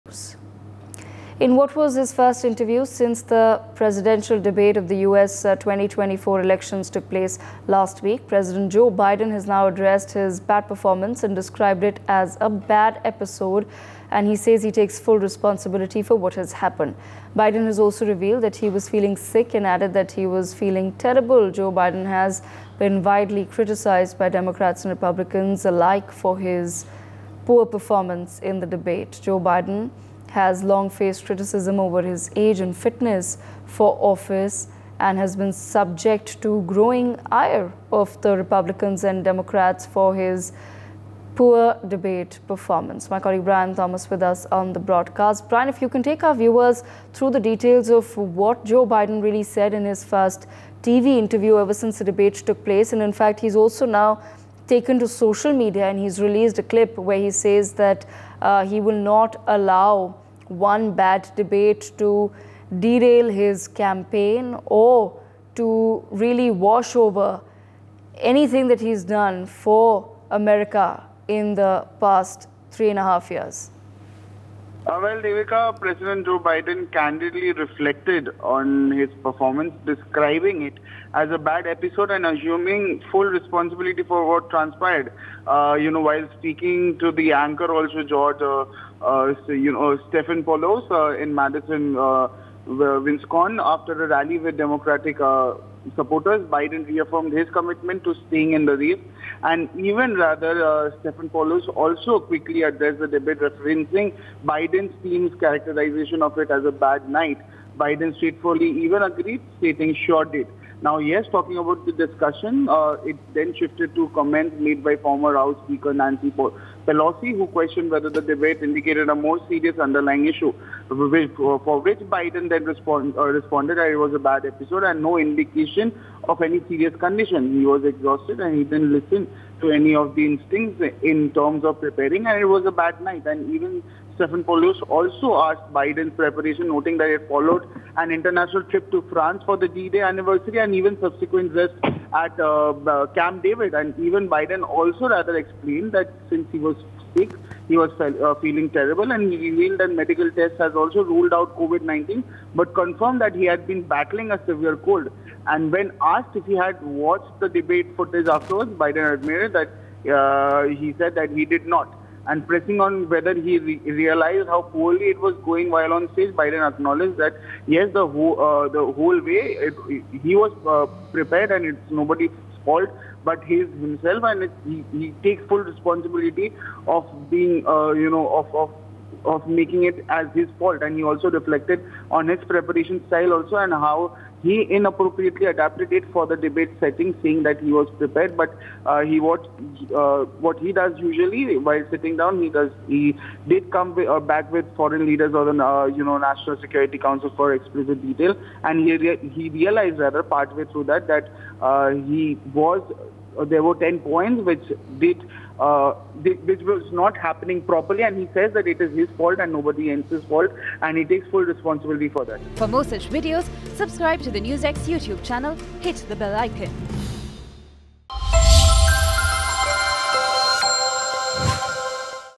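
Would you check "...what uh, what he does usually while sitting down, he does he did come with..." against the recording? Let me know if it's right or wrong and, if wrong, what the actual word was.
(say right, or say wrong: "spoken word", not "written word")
right.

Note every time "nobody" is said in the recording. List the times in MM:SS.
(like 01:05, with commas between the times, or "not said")
02:51, 03:29.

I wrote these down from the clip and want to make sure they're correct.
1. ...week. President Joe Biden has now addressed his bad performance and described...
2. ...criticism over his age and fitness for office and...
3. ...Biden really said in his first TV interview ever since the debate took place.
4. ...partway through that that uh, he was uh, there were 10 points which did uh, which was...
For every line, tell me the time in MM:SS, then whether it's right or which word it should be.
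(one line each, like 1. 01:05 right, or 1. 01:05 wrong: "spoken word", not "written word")
1. 00:08 right
2. 00:31 right
3. 00:48 right
4. 03:20 right.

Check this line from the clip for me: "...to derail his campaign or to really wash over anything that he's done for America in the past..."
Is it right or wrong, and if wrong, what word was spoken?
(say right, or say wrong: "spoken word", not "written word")
right.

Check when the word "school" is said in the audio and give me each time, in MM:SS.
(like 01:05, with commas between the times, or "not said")
not said.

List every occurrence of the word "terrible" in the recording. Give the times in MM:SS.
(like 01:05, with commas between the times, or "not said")
00:20, 02:28.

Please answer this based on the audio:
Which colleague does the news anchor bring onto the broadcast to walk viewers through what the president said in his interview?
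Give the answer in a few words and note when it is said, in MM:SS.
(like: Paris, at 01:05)
Brian Thomas, at 00:43.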